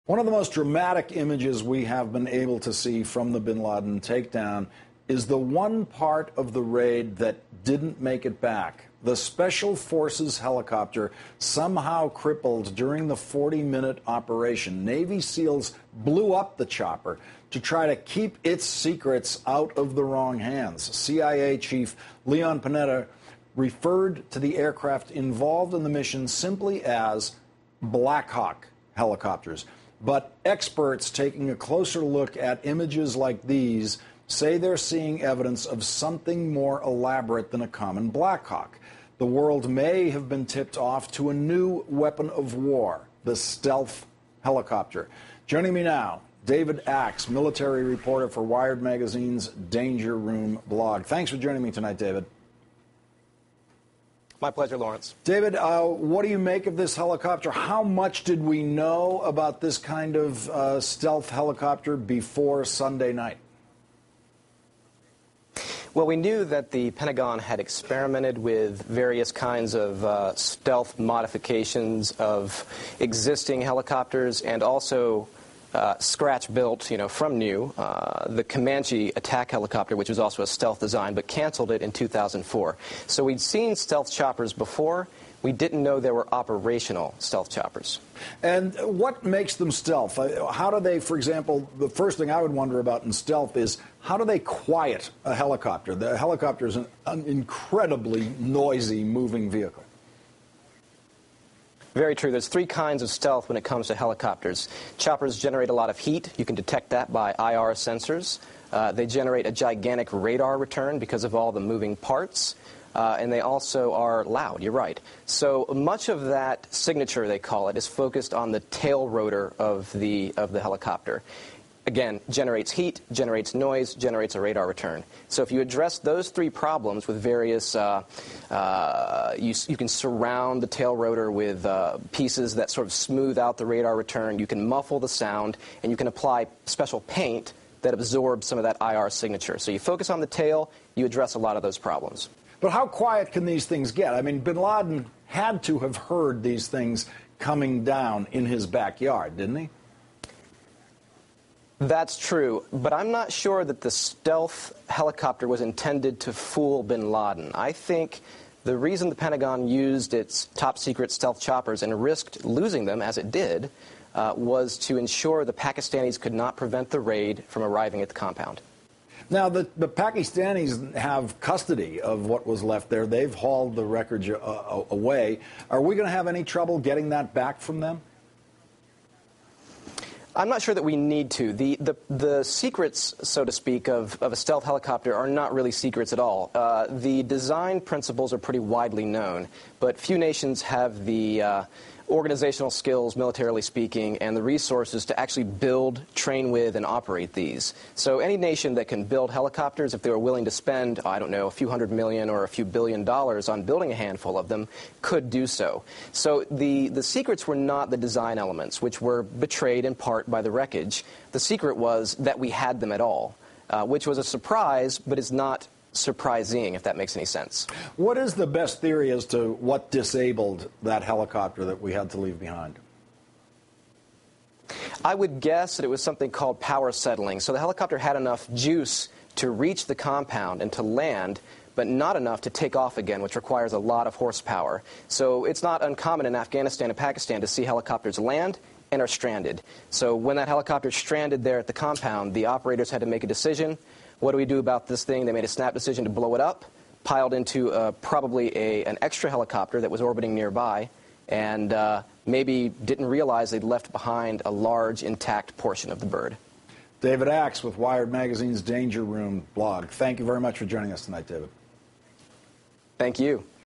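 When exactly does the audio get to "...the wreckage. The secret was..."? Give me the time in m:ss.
3:30.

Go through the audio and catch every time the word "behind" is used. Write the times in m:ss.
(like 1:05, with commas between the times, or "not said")
3:42, 4:13.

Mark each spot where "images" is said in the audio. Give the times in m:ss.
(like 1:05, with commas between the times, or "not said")
0:01, 0:32.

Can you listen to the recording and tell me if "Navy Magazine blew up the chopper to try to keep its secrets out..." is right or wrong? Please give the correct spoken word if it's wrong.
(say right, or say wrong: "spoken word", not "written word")
wrong: "SEALs", not "Magazine".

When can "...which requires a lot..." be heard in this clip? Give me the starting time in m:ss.
3:53.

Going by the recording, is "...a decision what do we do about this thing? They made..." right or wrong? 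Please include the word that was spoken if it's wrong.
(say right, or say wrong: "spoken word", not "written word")
right.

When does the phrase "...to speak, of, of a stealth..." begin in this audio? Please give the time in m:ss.
3:03.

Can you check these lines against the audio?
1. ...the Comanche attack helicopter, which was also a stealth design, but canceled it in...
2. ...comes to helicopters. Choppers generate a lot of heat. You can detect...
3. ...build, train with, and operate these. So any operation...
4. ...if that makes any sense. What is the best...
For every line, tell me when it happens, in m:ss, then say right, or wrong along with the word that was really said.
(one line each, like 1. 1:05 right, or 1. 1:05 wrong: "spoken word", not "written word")
1. 1:18 right
2. 1:43 right
3. 3:15 wrong: "nation", not "operation"
4. 3:36 right.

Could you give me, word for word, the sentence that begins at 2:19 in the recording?
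So you focus on the tail, you address a lot of those problems.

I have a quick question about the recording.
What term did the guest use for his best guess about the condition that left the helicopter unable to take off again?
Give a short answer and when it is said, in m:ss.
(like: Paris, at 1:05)
power settling, at 3:46.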